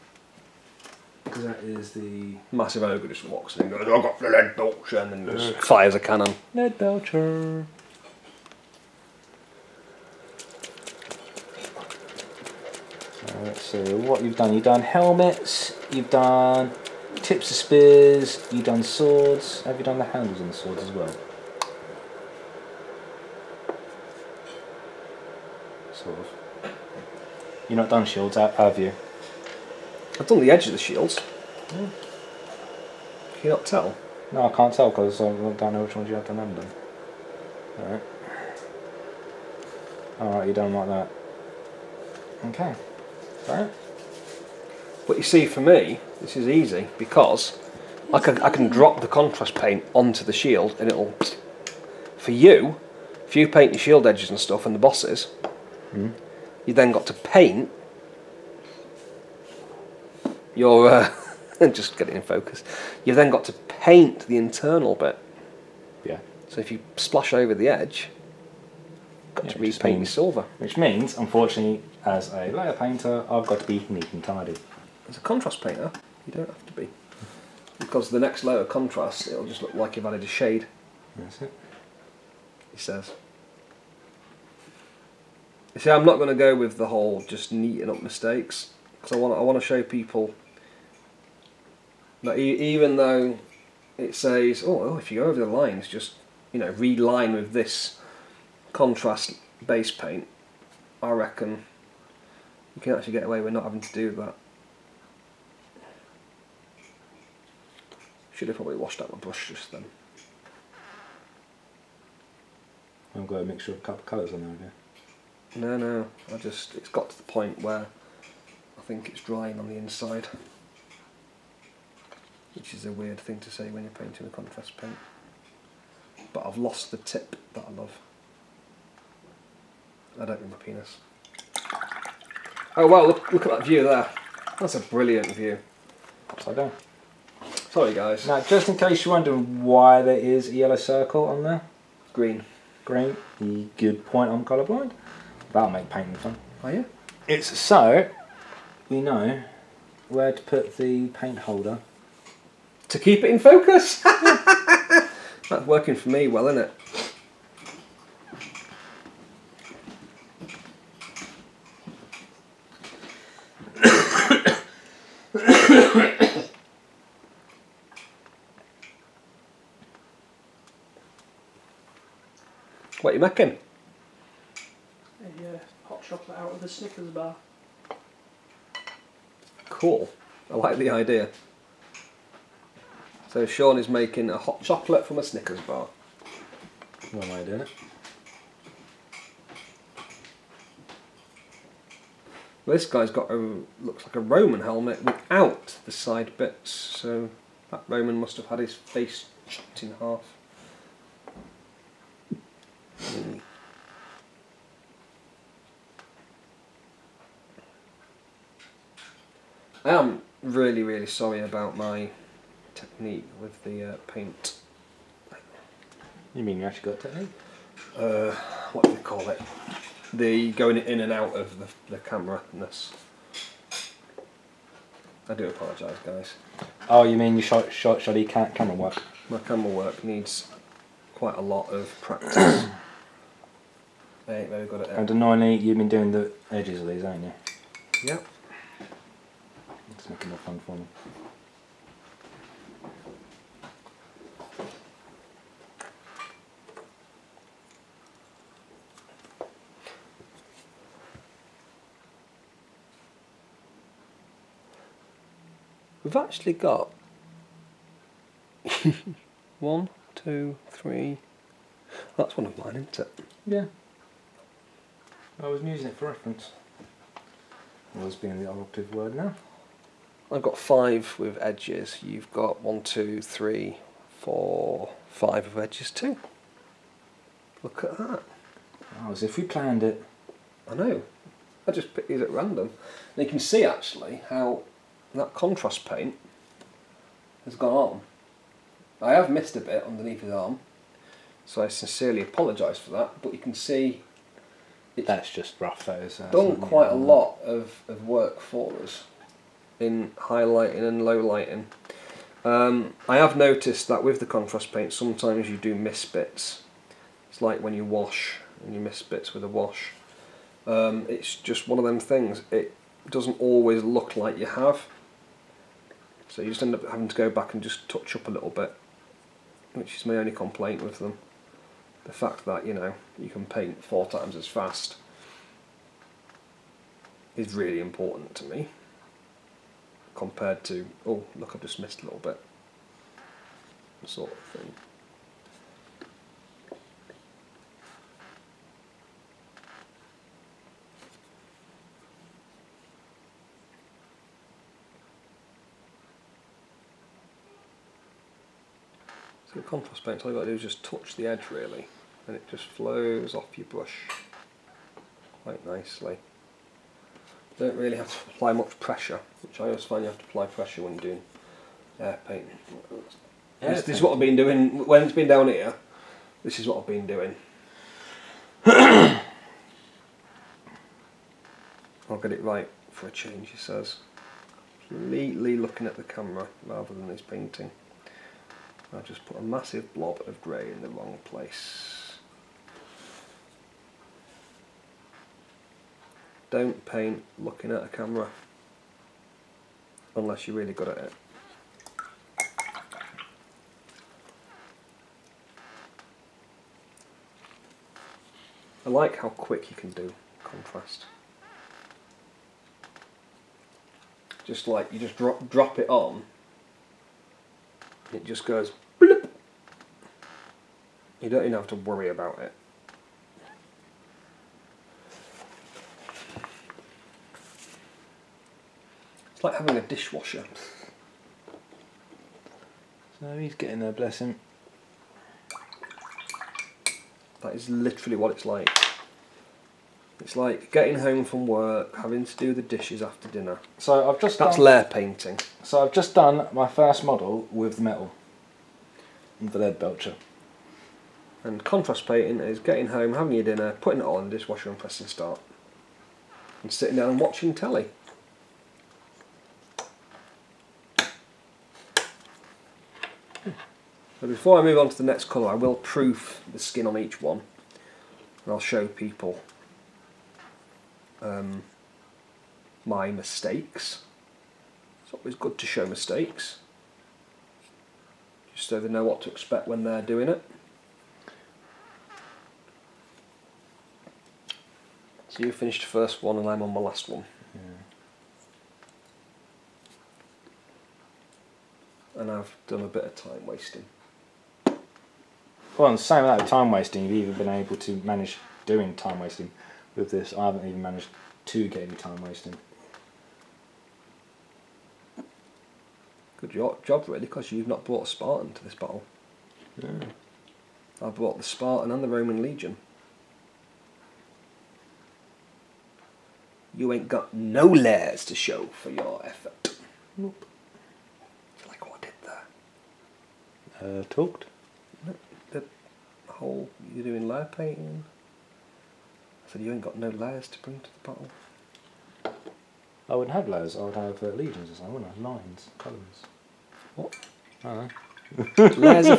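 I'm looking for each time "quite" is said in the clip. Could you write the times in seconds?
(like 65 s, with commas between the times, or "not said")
231 s, 296 s, 355 s.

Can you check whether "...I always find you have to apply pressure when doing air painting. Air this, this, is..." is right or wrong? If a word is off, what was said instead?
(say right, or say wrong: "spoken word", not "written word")
right.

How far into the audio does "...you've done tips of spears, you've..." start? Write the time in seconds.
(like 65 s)
15 s.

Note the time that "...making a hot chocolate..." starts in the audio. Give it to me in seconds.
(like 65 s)
183 s.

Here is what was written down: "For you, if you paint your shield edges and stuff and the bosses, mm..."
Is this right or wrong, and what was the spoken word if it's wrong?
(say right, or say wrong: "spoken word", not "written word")
right.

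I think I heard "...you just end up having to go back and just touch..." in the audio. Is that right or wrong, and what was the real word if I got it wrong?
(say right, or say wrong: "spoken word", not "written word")
right.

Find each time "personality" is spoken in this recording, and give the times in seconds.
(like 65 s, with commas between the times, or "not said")
not said.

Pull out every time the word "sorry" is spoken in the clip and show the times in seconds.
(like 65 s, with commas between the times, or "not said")
137 s, 211 s.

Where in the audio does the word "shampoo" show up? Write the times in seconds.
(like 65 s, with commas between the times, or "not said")
not said.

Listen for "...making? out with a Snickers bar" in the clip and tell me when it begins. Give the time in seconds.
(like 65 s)
173 s.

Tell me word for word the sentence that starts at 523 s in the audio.
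I wouldn't have layers, I would have uh, legions or something, wouldn't I?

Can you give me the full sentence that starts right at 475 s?
So you finished the first one and I'm on my last one.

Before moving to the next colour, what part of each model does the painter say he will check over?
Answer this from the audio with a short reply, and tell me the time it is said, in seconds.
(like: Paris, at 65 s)
The skin, at 456 s.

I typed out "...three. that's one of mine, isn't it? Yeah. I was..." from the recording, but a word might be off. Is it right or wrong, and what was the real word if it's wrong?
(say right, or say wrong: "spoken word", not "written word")
right.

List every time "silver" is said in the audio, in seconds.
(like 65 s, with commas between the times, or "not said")
70 s.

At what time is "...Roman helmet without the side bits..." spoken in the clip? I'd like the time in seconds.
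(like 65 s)
194 s.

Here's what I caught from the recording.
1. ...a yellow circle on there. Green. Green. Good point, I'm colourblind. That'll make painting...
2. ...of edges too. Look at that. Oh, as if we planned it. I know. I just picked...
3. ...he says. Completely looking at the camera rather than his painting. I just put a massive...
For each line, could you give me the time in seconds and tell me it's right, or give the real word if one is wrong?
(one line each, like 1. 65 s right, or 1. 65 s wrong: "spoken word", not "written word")
1. 140 s right
2. 275 s right
3. 373 s right.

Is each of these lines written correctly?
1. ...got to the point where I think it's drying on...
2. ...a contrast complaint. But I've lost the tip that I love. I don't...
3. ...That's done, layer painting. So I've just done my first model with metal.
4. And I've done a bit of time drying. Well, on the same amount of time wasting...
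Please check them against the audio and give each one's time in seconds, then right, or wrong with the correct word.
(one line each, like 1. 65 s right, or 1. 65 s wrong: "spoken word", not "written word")
1. 116 s right
2. 124 s wrong: "paint", not "complaint"
3. 434 s right
4. 482 s wrong: "wasting", not "drying".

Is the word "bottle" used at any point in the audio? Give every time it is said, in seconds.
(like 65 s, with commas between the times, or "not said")
521 s.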